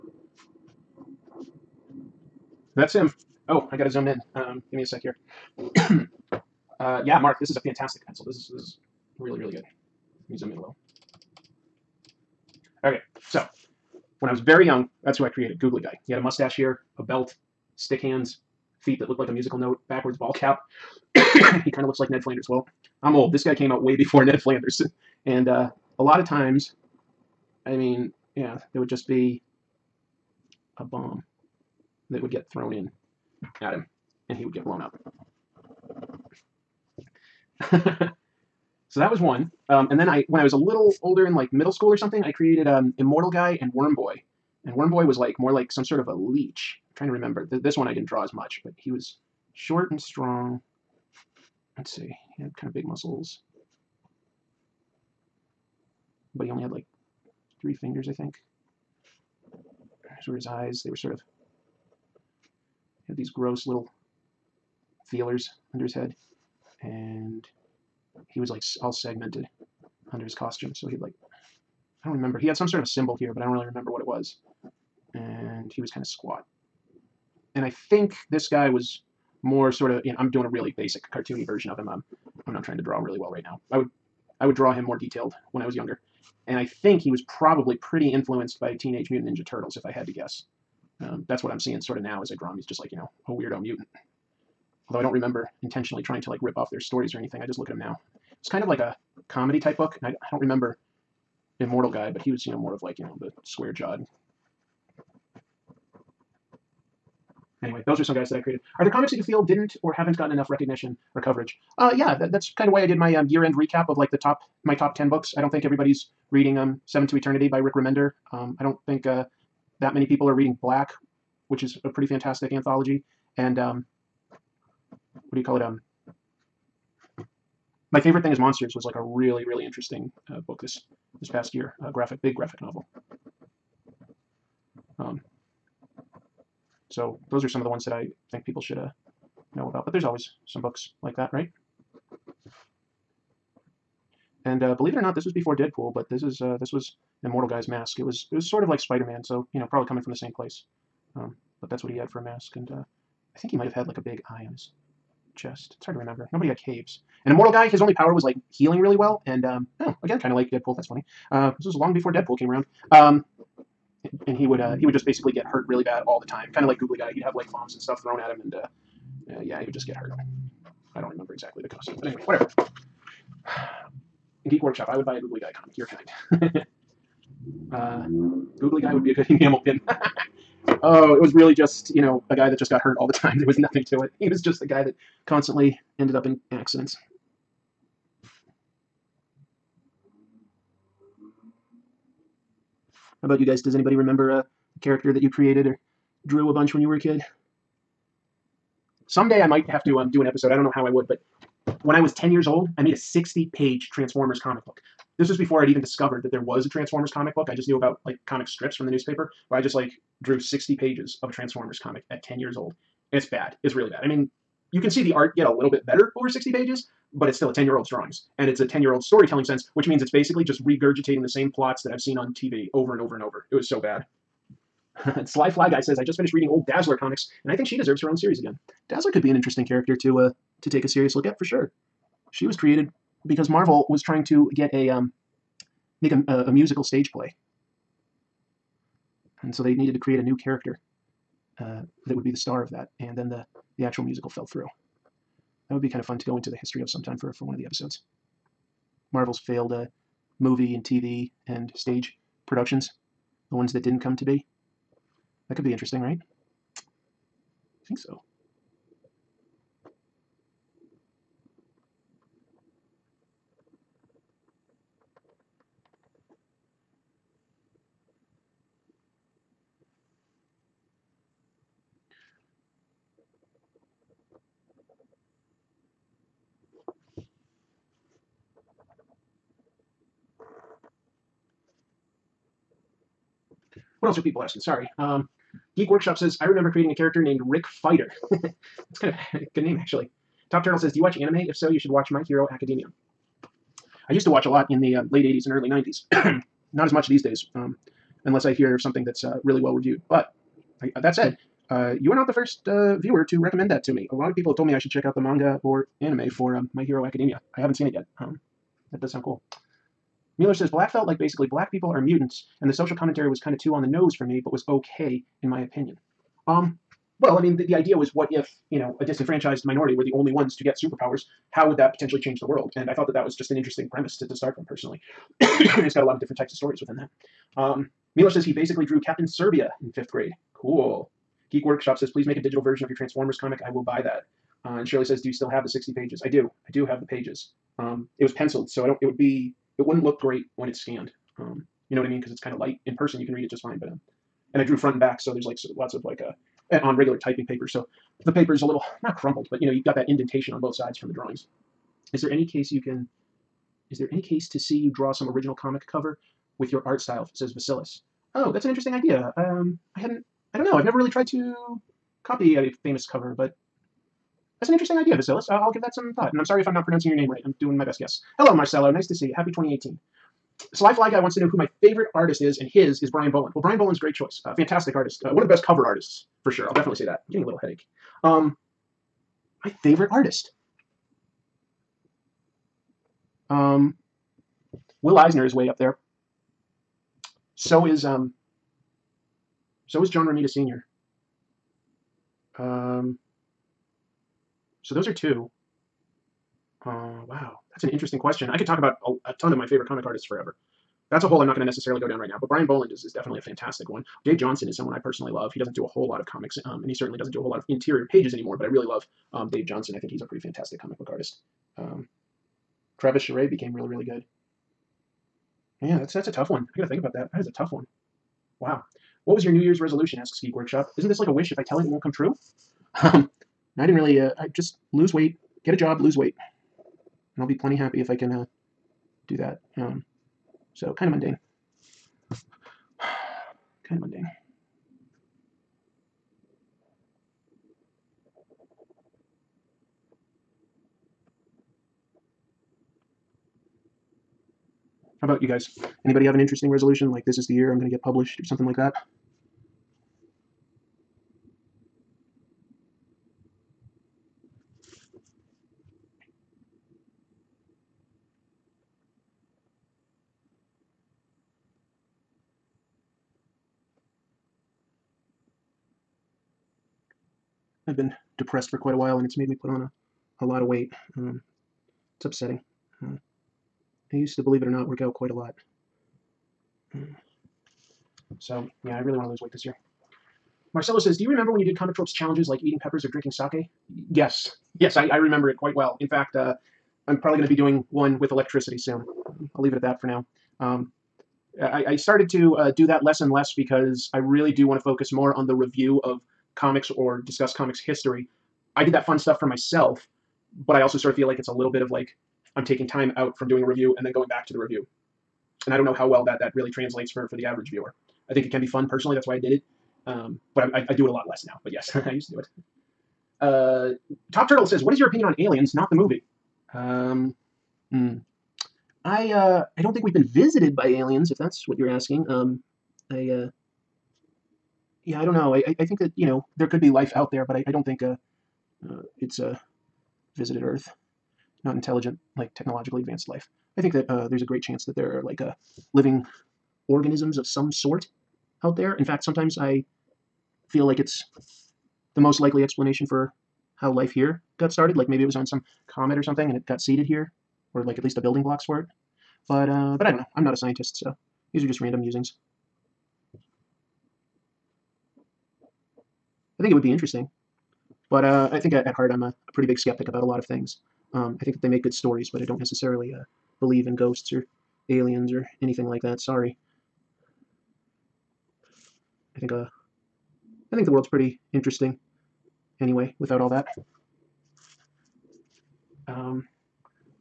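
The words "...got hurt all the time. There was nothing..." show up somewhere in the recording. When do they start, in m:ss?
3:02.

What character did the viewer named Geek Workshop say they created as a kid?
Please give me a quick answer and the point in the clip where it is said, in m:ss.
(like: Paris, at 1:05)
Rick Fighter, at 4:47.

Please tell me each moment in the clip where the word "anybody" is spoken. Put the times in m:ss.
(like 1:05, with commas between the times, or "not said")
3:13, 7:26.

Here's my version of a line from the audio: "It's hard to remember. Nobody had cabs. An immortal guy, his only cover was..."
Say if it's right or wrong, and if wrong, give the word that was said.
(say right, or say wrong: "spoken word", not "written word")
wrong: "power", not "cover".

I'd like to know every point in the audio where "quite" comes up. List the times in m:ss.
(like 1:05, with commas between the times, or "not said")
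7:48, 7:55, 8:05.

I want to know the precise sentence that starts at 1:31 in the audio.
Um, that's what I'm seeing sort of now as I draw him.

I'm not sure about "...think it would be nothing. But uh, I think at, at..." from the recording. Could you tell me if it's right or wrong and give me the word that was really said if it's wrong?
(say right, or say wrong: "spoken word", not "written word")
wrong: "interesting", not "nothing".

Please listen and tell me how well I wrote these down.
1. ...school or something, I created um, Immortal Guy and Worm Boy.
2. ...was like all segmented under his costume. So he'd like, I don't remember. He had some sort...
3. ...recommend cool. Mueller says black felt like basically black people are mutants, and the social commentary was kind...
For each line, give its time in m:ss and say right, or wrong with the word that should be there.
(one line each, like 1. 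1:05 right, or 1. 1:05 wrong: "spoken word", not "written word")
1. 0:41 right
2. 1:08 right
3. 5:09 wrong: "sound", not "recommend".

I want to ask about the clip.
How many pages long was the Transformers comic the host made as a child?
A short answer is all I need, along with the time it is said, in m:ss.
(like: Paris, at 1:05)
60, at 3:22.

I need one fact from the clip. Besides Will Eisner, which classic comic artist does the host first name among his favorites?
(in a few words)
John Romita Sr.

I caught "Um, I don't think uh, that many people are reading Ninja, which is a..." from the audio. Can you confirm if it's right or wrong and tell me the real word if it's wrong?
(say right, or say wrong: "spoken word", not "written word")
wrong: "Black", not "Ninja".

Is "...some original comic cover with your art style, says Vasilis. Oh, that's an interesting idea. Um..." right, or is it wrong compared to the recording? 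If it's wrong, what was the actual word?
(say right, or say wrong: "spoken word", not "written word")
right.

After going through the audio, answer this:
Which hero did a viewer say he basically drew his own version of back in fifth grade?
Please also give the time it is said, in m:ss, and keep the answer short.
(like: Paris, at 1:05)
Captain Serbia, at 5:29.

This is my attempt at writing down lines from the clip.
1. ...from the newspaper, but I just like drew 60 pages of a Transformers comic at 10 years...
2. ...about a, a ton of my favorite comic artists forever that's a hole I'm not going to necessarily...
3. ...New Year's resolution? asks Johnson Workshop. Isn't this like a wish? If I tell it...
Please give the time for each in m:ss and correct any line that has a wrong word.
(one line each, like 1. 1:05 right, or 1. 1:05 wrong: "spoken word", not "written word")
1. 3:28 right
2. 6:38 right
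3. 6:59 wrong: "Geek", not "Johnson".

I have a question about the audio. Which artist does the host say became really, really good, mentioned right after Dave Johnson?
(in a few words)
Travis Charest.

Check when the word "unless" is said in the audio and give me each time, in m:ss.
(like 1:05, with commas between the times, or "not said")
4:58.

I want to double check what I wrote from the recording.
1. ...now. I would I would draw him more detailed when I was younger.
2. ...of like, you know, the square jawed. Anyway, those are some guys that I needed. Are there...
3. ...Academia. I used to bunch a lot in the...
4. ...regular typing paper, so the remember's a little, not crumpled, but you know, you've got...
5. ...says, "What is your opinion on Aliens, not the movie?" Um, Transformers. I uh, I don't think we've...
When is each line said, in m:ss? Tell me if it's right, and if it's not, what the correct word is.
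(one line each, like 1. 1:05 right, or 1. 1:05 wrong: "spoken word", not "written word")
1. 1:23 right
2. 1:42 wrong: "created", not "needed"
3. 4:52 wrong: "watch", not "bunch"
4. 5:46 wrong: "paper", not "remember"
5. 8:34 wrong: "Hmm", not "Transformers".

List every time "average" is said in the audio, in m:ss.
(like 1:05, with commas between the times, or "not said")
8:27.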